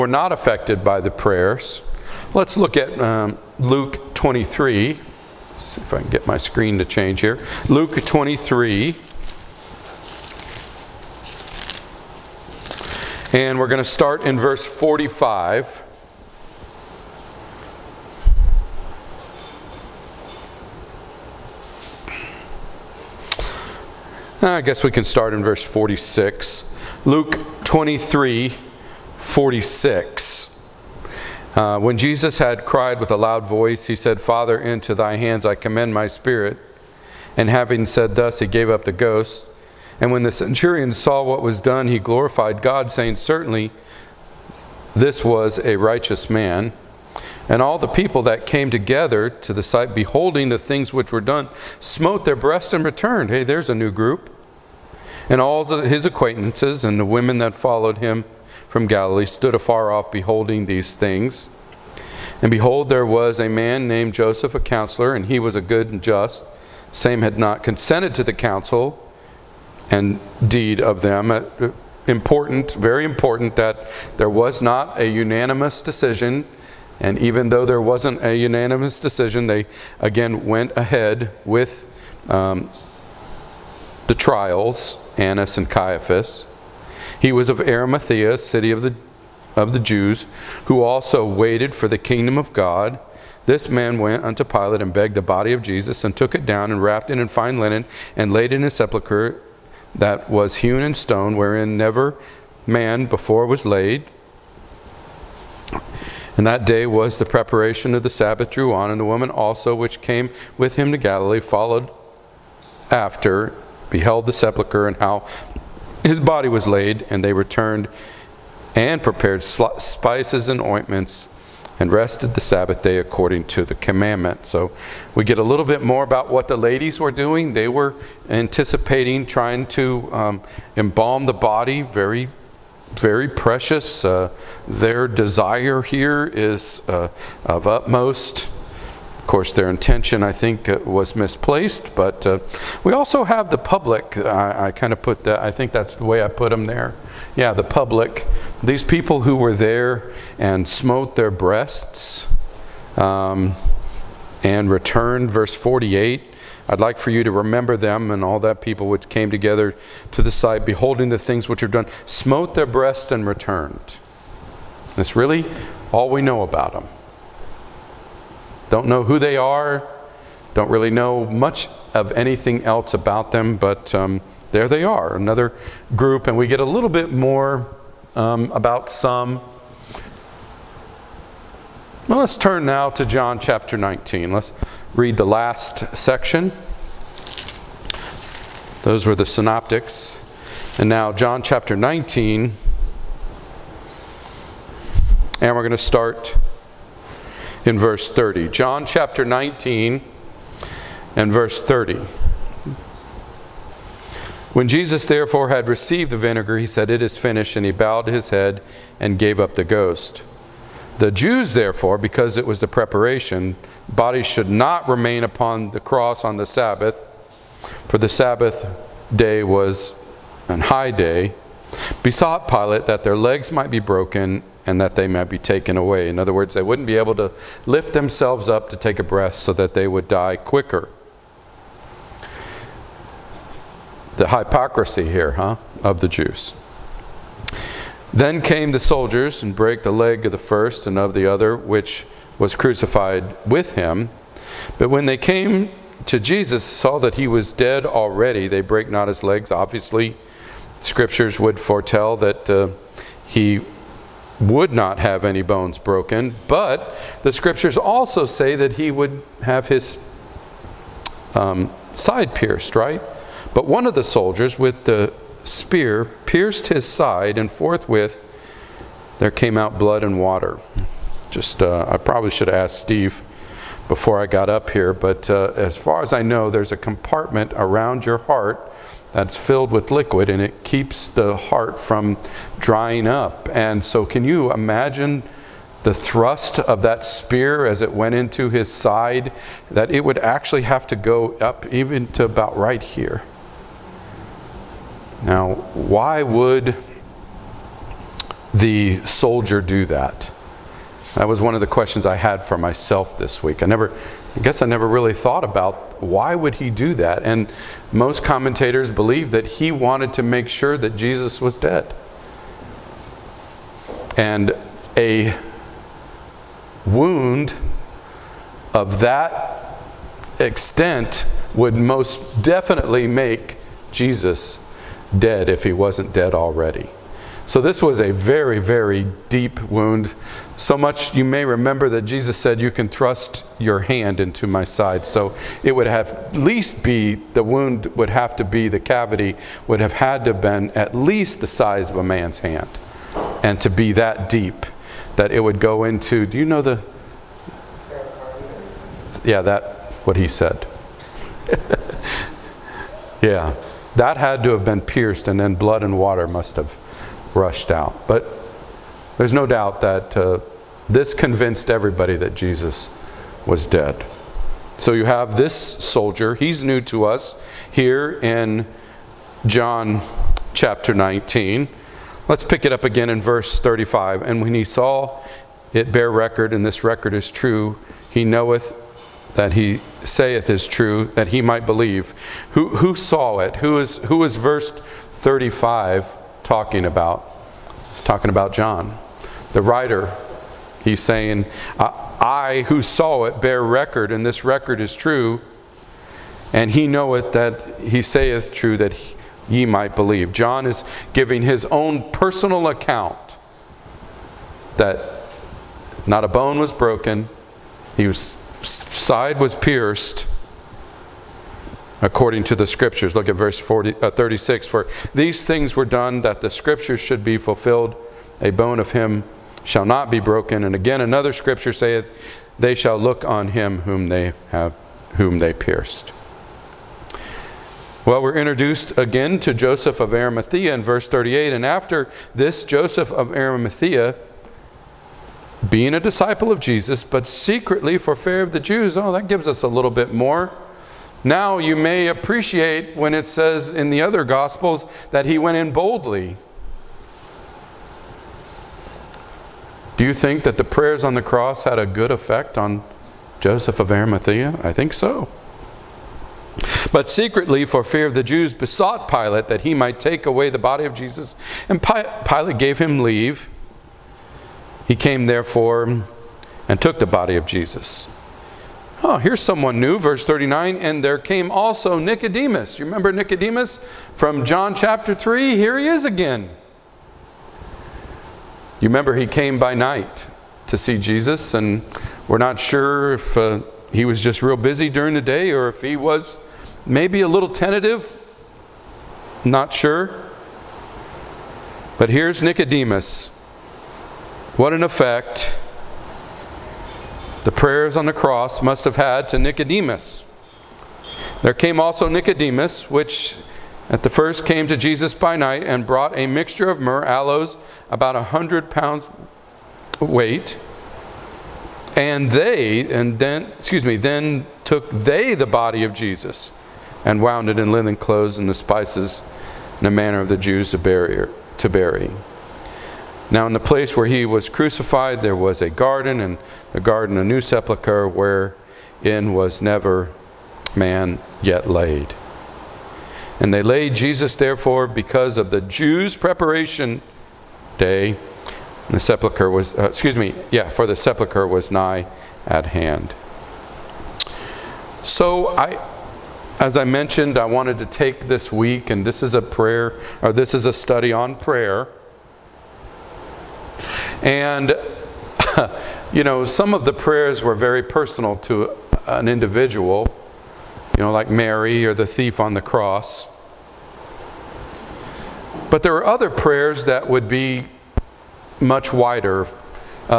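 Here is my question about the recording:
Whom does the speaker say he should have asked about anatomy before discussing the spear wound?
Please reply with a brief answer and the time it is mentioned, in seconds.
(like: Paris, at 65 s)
Steve, at 272 s.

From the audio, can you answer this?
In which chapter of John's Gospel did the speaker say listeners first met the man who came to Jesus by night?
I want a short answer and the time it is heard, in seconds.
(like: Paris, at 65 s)
John 3, at 474 s.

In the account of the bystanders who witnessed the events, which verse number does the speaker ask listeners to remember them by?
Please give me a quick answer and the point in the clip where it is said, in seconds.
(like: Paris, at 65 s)
48, at 155 s.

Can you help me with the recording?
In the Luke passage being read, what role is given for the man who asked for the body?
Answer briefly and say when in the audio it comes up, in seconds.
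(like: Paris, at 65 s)
A counselor, at 64 s.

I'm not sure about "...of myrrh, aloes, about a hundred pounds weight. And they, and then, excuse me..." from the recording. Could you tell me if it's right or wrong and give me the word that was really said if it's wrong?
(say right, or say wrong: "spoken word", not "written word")
right.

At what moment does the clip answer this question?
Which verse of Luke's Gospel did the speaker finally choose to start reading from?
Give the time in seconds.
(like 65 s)
27 s.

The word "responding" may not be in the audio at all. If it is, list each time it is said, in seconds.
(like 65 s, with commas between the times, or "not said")
not said.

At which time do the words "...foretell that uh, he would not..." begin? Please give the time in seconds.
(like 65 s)
251 s.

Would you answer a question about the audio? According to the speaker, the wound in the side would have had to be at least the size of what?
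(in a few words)
A man's hand.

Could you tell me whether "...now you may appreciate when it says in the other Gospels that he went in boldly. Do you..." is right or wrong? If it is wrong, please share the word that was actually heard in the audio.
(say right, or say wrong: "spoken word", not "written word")
right.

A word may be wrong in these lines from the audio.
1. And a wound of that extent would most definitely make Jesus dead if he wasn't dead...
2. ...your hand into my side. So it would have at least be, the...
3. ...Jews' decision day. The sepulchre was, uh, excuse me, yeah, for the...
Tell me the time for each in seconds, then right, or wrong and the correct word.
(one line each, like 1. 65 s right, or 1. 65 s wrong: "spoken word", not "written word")
1. 314 s right
2. 333 s right
3. 535 s wrong: "preparation", not "decision".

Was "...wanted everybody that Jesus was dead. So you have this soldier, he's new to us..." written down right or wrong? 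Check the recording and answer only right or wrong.
wrong.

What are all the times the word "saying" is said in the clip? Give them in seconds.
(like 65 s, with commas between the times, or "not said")
42 s, 391 s.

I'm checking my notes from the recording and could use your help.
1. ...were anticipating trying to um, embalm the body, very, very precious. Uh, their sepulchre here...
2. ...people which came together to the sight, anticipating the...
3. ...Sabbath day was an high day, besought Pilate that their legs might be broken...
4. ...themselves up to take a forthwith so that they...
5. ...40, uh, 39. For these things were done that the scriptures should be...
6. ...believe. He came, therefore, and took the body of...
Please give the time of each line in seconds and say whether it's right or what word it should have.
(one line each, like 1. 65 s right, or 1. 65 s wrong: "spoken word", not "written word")
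1. 127 s wrong: "desire", not "sepulchre"
2. 158 s wrong: "beholding", not "anticipating"
3. 218 s right
4. 227 s wrong: "breath", not "forthwith"
5. 413 s wrong: "36", not "39"
6. 463 s wrong: "leave", not "believe".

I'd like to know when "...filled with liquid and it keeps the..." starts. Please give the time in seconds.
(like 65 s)
279 s.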